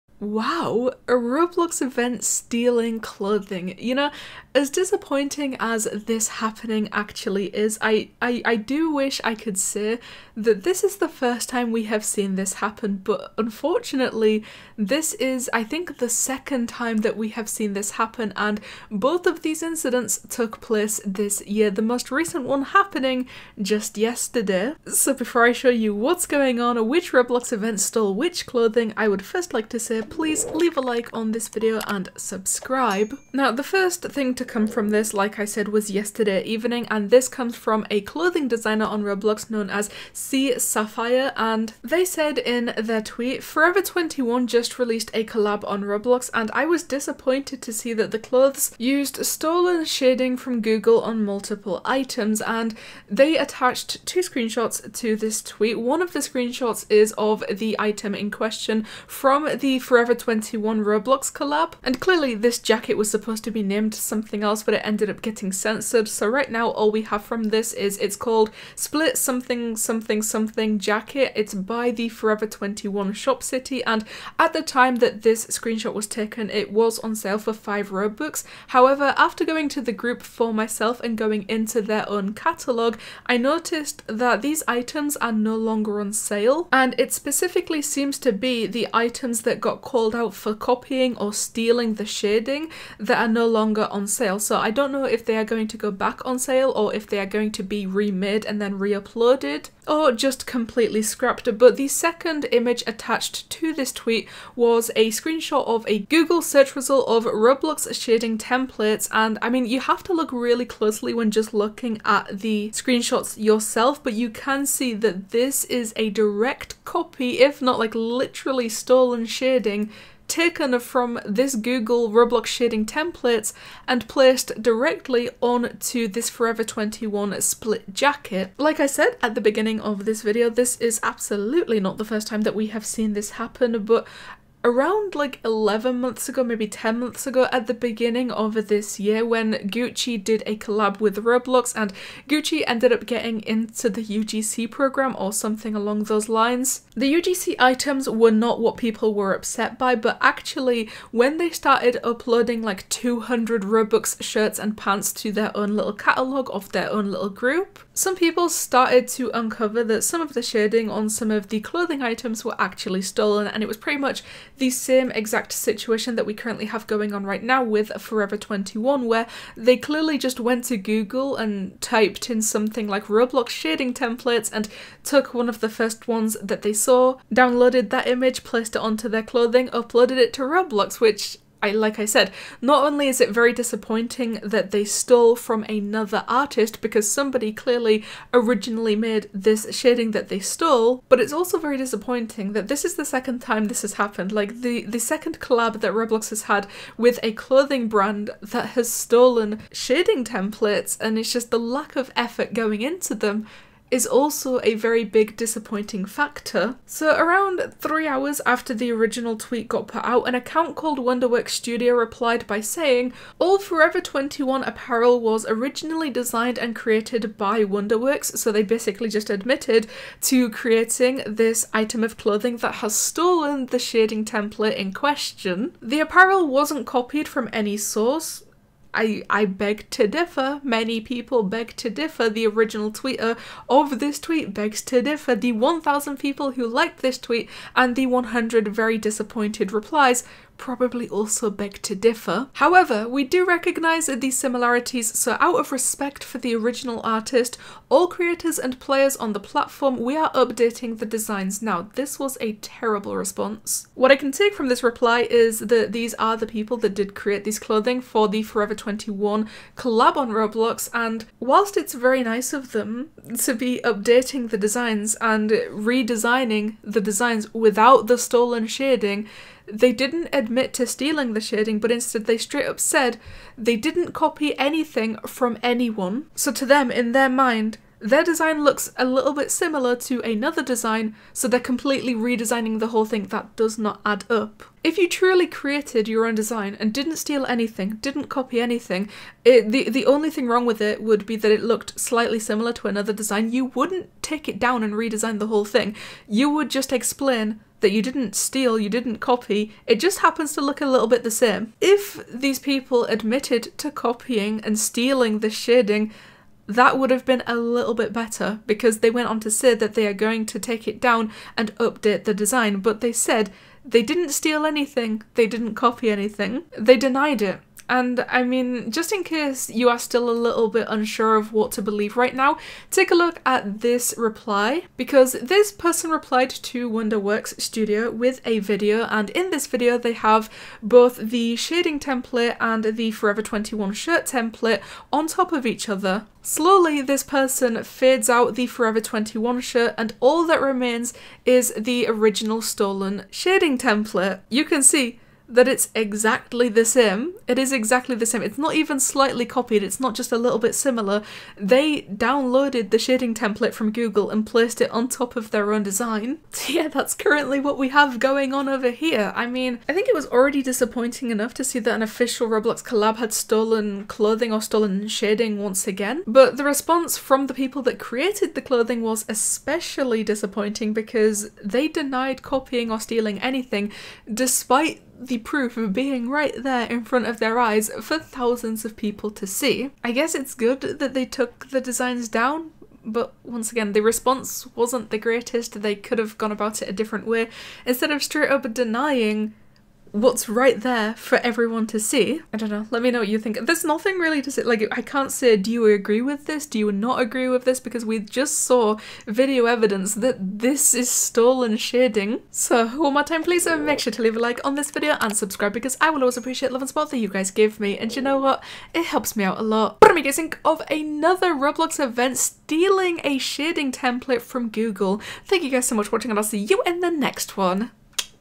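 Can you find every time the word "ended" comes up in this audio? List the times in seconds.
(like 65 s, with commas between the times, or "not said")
64 s, 142 s.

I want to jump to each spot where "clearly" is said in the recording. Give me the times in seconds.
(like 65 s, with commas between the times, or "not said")
61 s, 169 s, 187 s.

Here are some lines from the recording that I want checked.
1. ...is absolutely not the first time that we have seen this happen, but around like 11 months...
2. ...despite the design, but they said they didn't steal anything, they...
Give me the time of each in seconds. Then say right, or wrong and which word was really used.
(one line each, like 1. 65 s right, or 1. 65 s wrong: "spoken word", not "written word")
1. 130 s right
2. 311 s wrong: "update", not "despite".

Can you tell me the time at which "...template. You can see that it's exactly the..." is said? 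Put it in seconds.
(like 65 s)
343 s.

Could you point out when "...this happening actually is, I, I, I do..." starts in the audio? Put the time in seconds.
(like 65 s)
5 s.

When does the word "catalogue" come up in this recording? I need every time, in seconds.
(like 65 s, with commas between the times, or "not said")
82 s, 155 s.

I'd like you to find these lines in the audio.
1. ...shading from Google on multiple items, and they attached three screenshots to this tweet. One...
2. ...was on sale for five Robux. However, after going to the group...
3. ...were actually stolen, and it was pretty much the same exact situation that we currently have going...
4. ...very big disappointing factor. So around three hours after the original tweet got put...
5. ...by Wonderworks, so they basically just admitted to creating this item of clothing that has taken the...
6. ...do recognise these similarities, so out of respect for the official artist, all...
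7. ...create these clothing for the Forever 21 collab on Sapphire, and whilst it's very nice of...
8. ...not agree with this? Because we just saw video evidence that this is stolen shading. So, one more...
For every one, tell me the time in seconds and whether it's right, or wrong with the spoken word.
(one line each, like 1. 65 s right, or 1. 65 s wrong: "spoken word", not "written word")
1. 49 s wrong: "two", not "three"
2. 76 s right
3. 162 s right
4. 204 s right
5. 217 s wrong: "stolen", not "taken"
6. 243 s wrong: "original", not "official"
7. 257 s wrong: "Roblox", not "Sapphire"
8. 396 s right.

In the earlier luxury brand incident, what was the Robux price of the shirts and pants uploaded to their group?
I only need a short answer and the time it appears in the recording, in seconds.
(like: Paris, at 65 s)
200 Robux, at 152 s.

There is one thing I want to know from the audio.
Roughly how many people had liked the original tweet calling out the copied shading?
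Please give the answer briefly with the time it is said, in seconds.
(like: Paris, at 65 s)
1,000, at 235 s.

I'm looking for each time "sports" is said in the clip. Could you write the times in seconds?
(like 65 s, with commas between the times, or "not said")
not said.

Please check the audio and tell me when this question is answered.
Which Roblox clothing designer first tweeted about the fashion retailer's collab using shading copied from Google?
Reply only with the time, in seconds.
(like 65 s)
40 s.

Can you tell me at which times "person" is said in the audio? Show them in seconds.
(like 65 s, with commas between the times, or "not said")
325 s, 337 s.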